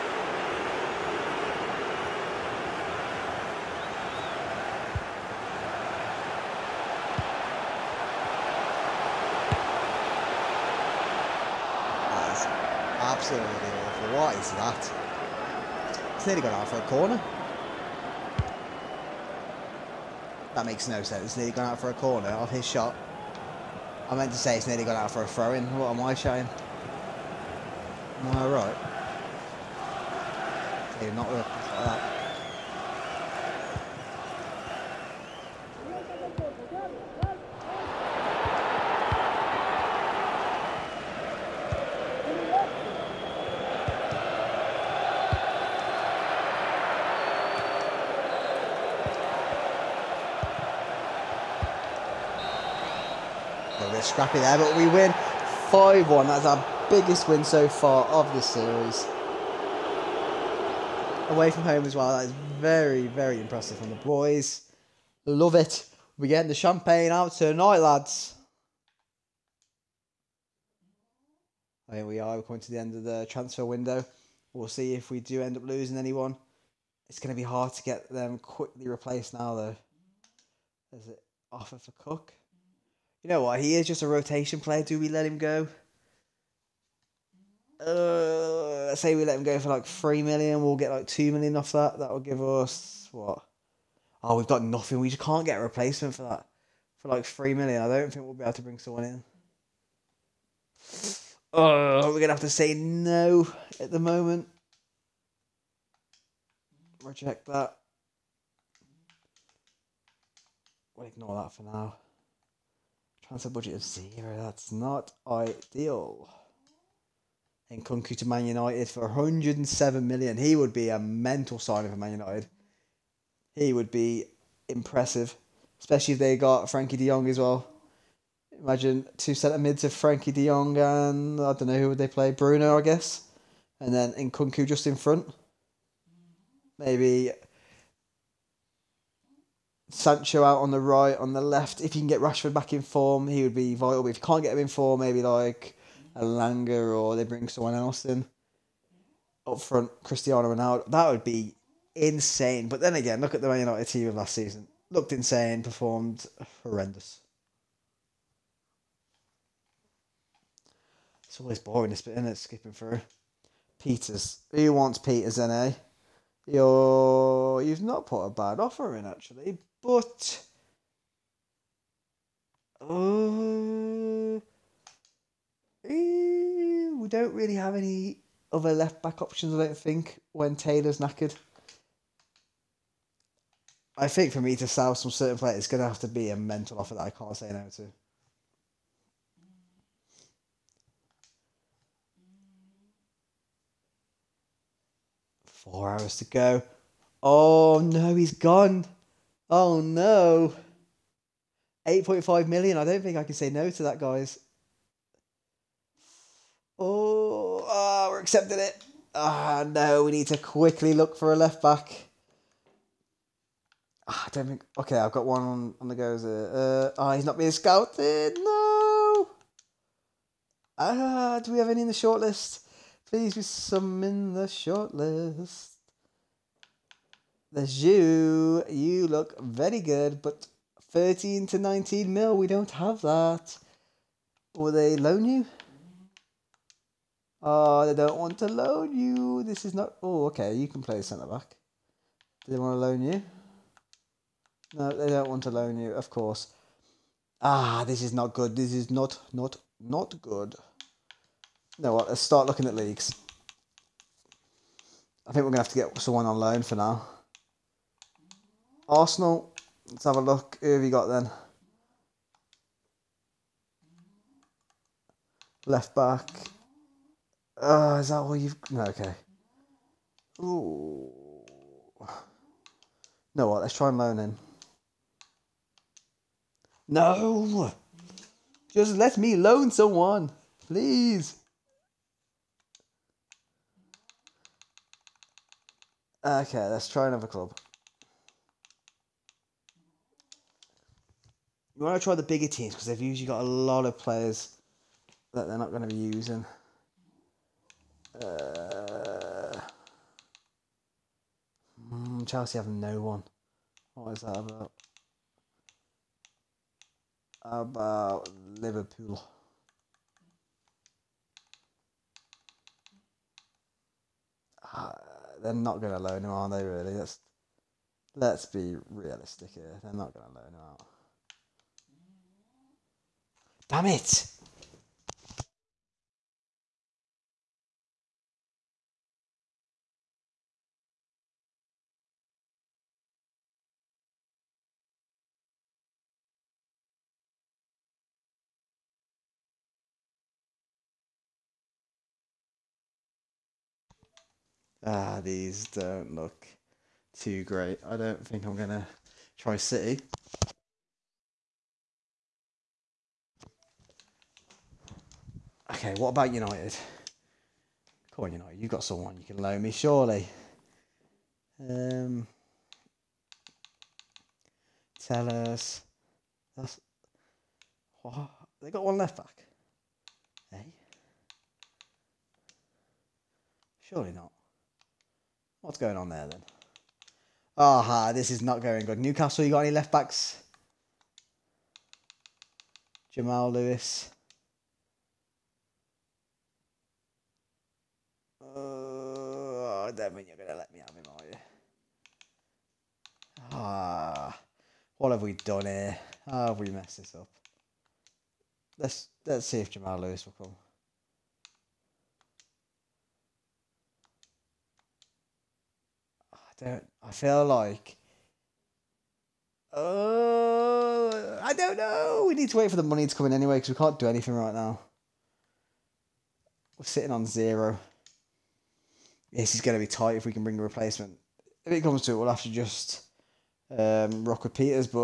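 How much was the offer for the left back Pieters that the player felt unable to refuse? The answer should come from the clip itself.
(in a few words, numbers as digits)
8.5 million.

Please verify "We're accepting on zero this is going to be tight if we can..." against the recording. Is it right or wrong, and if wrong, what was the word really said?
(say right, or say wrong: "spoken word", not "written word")
wrong: "sitting", not "accepting".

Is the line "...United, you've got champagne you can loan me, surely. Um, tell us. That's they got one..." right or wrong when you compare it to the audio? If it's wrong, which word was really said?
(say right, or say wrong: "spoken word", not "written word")
wrong: "someone", not "champagne".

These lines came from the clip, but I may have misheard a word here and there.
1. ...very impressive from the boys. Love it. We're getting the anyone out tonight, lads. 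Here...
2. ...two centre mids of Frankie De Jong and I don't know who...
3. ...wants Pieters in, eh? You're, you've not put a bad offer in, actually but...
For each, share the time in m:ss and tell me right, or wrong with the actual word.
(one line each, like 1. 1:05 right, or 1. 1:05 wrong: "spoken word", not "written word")
1. 1:03 wrong: "champagne", not "anyone"
2. 2:09 right
3. 2:44 right.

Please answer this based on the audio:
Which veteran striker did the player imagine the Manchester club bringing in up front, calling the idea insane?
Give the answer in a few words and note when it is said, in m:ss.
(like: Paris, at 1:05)
Cristiano Ronaldo, at 2:30.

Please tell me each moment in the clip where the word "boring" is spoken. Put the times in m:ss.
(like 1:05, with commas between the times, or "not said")
2:41.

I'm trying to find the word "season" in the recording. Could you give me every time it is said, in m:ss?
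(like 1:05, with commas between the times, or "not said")
2:34.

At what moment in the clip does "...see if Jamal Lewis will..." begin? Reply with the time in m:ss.
6:39.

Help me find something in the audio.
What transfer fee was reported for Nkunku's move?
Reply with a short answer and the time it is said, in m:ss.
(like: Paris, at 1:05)
107 million, at 1:59.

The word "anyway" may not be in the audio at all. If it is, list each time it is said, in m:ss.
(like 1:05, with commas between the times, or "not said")
6:53.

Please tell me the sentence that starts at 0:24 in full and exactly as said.
I meant to say it's nearly gone out for a throw-in.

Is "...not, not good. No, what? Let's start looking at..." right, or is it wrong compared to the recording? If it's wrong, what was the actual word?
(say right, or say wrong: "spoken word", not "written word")
right.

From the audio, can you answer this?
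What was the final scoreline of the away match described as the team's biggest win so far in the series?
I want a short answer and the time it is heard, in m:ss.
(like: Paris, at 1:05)
5-1, at 0:55.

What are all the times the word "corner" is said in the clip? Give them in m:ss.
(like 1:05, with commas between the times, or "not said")
0:16, 0:21.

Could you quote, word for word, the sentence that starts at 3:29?
Ah, oh, no, we need to quickly look for a left back.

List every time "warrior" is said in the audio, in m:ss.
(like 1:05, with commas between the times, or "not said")
not said.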